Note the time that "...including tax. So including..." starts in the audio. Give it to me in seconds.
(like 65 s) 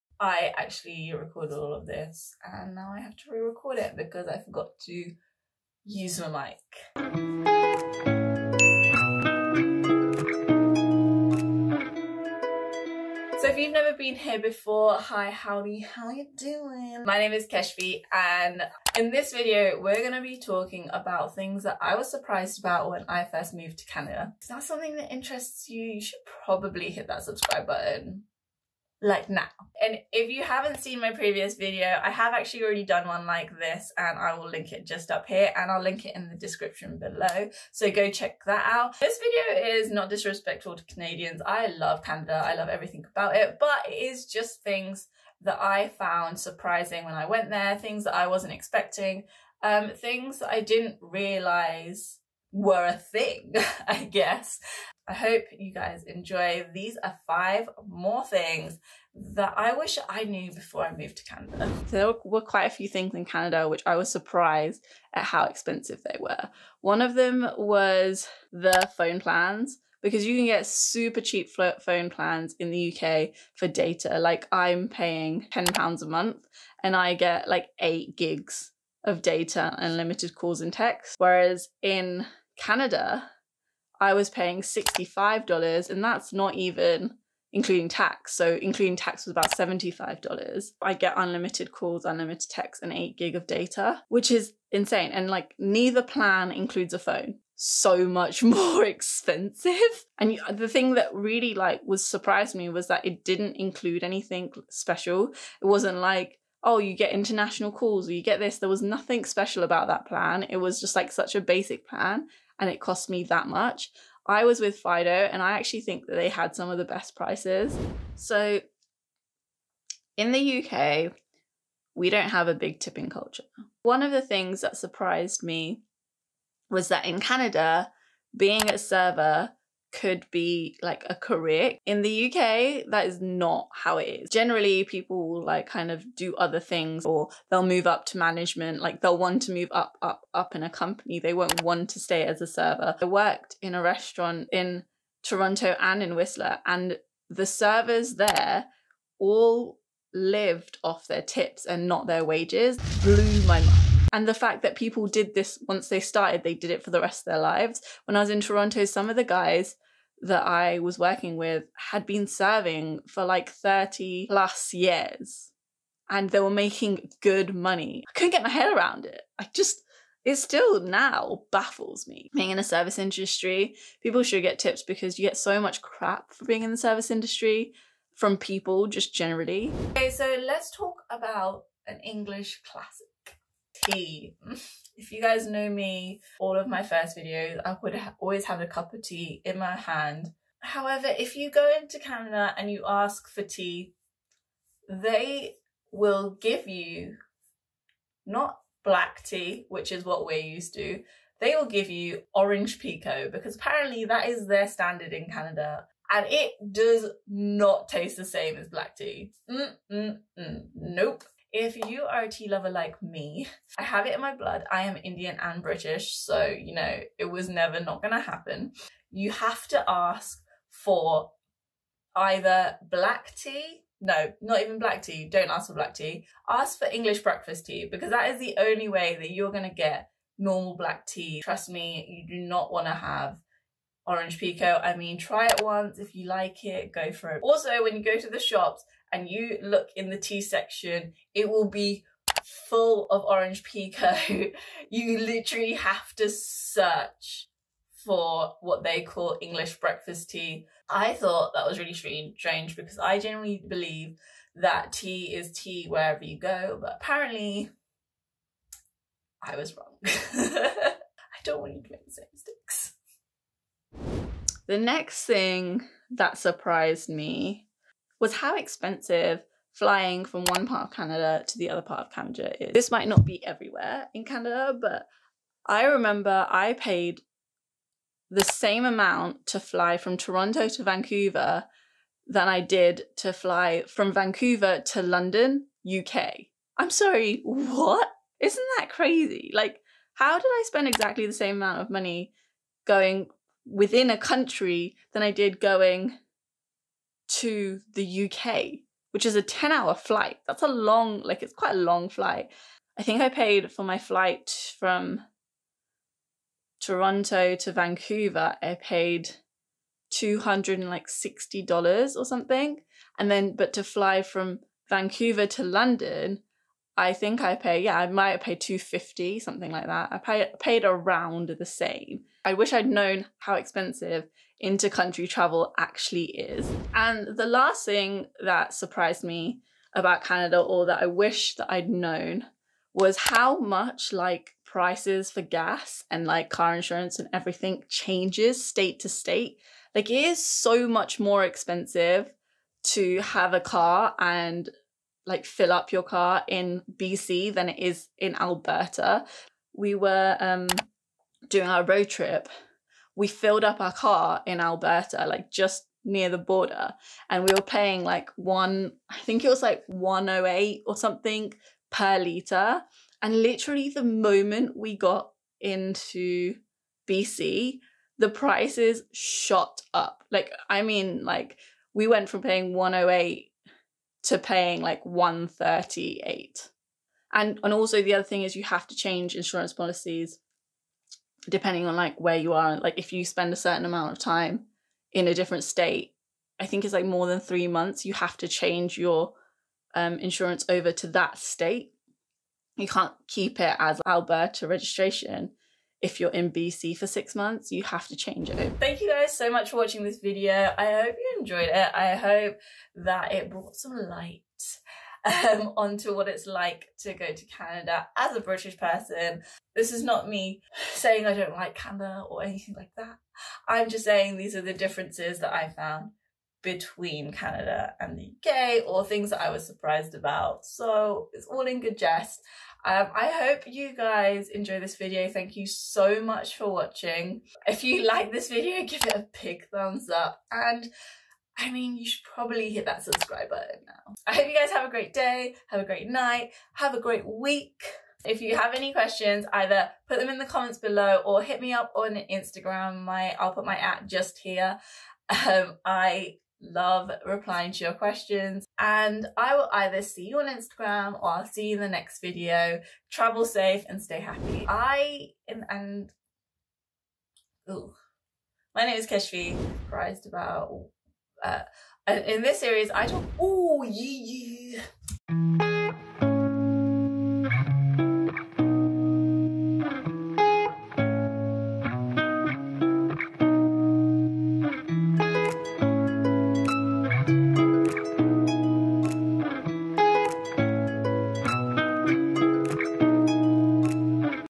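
87 s.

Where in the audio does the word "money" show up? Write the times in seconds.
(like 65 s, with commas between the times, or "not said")
167 s, 291 s.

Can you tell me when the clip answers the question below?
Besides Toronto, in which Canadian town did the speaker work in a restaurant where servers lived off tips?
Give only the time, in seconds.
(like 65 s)
146 s.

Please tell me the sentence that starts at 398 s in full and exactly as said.
Thank you guys so much for watching this video.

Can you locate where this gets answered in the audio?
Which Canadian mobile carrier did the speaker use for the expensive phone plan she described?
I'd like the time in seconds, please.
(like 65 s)
114 s.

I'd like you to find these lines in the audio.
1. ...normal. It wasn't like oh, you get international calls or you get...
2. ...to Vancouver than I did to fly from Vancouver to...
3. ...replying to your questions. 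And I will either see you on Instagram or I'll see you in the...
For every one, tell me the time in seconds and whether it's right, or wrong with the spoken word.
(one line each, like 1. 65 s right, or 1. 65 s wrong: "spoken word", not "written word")
1. 104 s wrong: "special", not "normal"
2. 280 s right
3. 447 s right.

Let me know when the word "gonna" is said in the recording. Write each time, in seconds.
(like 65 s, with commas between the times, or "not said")
218 s, 229 s.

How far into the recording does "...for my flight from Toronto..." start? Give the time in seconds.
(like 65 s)
303 s.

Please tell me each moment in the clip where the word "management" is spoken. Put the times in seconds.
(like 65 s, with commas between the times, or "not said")
138 s.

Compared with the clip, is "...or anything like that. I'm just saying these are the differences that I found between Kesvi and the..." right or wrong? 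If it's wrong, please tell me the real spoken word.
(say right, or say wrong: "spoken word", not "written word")
wrong: "Canada", not "Kesvi".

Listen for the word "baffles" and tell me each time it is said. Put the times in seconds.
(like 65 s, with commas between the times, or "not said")
171 s.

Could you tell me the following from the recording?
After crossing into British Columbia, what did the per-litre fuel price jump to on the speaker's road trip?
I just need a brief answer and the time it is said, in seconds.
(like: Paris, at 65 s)
138, at 375 s.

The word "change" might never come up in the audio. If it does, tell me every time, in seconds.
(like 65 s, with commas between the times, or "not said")
337 s, 378 s, 388 s, 398 s.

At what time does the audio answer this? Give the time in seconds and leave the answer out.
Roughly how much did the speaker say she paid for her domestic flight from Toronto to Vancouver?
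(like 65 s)
310 s.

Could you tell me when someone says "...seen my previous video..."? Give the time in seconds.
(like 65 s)
30 s.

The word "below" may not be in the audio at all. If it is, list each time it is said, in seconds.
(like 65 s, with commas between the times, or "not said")
36 s, 440 s.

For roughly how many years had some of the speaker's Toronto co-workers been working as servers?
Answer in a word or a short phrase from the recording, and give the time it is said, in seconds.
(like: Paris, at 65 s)
30 plus years, at 163 s.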